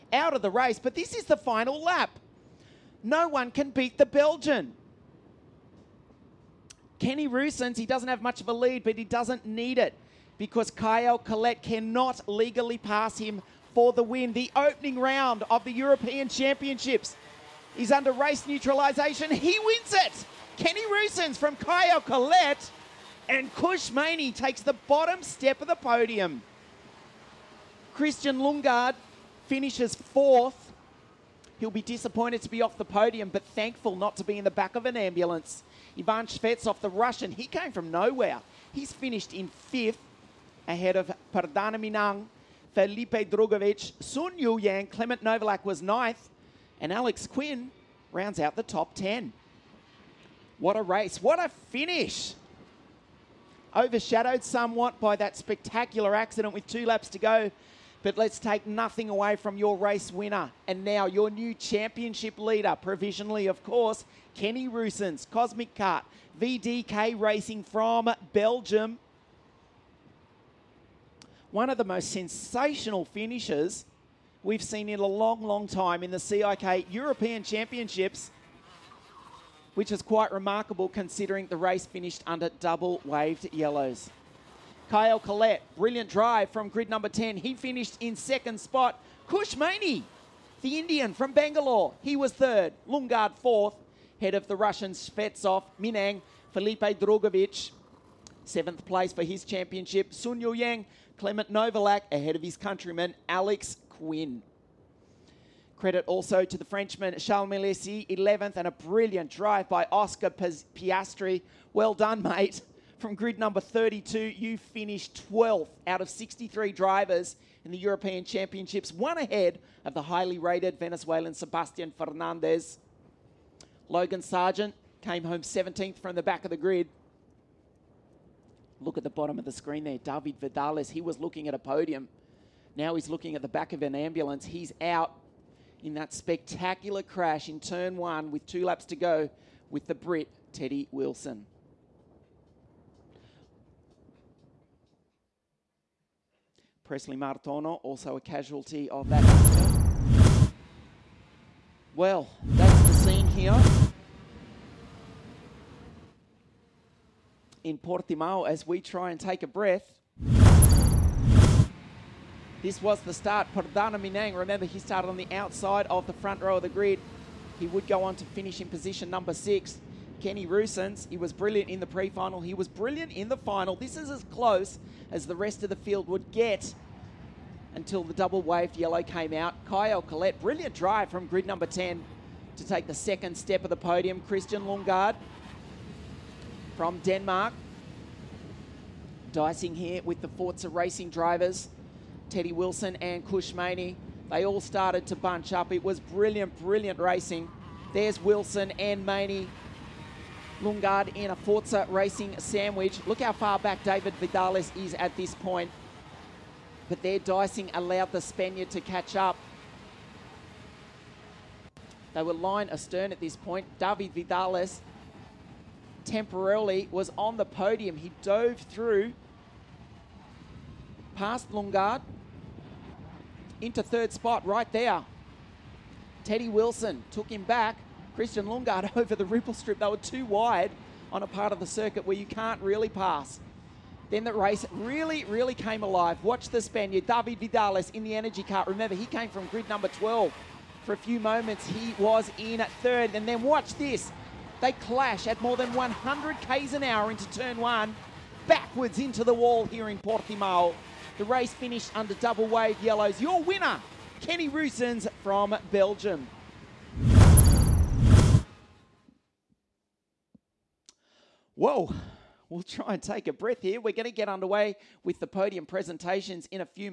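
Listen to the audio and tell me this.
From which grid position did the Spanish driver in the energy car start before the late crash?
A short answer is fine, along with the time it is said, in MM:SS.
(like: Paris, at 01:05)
12, at 03:59.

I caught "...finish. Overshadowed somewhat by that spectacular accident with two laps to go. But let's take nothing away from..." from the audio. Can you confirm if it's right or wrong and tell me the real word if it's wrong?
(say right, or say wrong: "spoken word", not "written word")
right.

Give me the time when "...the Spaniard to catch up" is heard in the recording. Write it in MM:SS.
03:28.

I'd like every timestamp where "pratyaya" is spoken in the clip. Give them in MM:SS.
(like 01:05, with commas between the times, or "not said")
not said.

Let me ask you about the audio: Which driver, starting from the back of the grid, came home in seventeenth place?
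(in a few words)
Logan Sargeant.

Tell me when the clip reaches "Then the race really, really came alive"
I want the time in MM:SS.
03:54.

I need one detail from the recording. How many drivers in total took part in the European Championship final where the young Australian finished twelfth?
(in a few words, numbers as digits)
63.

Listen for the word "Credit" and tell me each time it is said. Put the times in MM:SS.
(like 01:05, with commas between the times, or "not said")
01:45.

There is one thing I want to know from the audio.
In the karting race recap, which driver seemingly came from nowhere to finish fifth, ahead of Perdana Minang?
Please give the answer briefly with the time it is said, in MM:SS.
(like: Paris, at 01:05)
Ivan Shvetsov, at 00:35.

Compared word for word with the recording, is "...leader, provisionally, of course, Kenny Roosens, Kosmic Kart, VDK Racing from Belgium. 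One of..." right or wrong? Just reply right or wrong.
right.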